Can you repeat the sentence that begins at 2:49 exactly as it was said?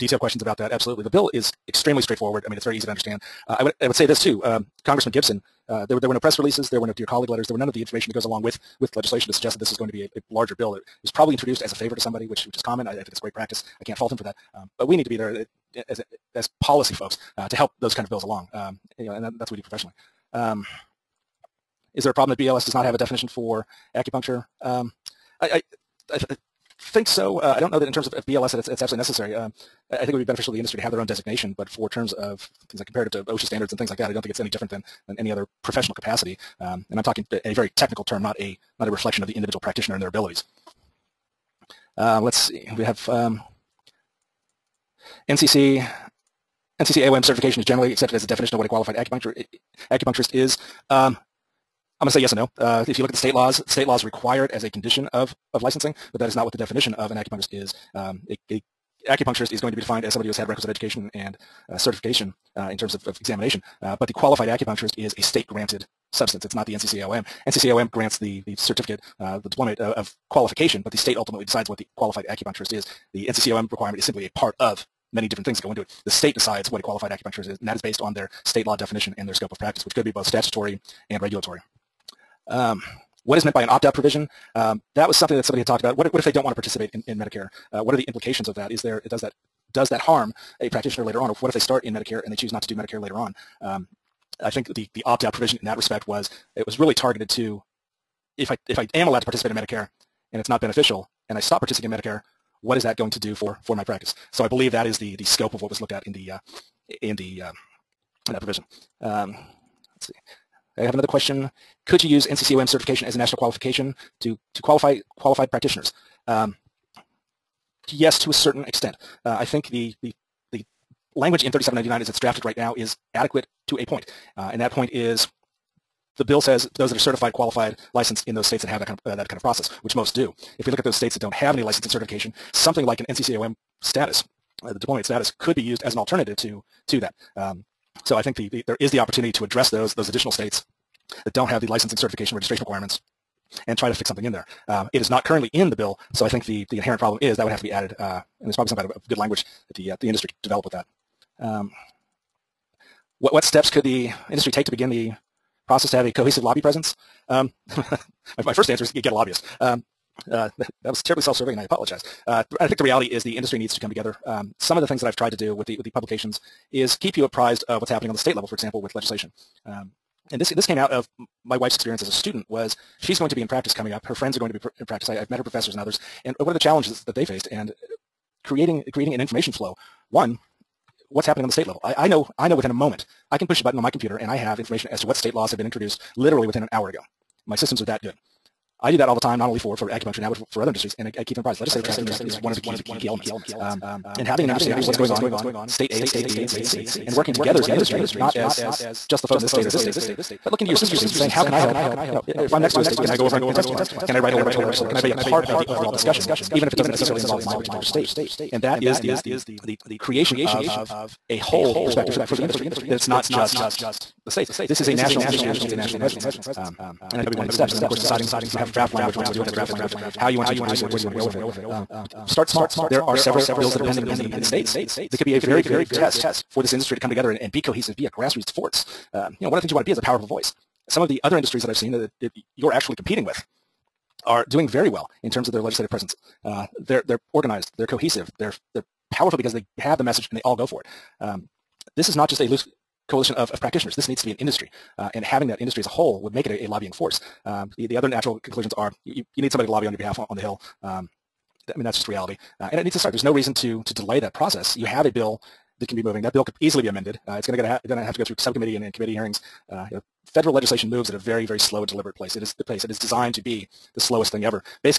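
Um, and this this came out of my wife's experience as a student was she's going to be in practice coming up.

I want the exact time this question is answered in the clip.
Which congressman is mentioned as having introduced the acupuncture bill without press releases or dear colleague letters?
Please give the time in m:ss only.
0:04.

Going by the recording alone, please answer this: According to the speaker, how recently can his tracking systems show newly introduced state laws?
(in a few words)
within an hour.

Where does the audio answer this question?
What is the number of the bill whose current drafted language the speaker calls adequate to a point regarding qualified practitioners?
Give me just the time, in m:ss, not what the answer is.
2:01.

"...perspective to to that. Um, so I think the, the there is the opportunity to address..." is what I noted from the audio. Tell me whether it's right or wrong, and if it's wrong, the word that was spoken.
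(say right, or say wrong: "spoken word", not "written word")
wrong: "alternative", not "perspective".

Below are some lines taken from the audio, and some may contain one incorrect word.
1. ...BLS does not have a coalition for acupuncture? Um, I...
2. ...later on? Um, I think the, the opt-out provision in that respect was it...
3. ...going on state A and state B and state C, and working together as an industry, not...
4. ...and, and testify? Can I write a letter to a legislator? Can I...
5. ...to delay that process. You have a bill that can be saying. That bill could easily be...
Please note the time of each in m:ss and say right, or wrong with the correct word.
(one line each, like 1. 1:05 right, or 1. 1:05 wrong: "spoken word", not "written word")
1. 0:22 wrong: "definition", not "coalition"
2. 1:33 right
3. 3:14 right
4. 3:23 right
5. 4:13 wrong: "moving", not "saying".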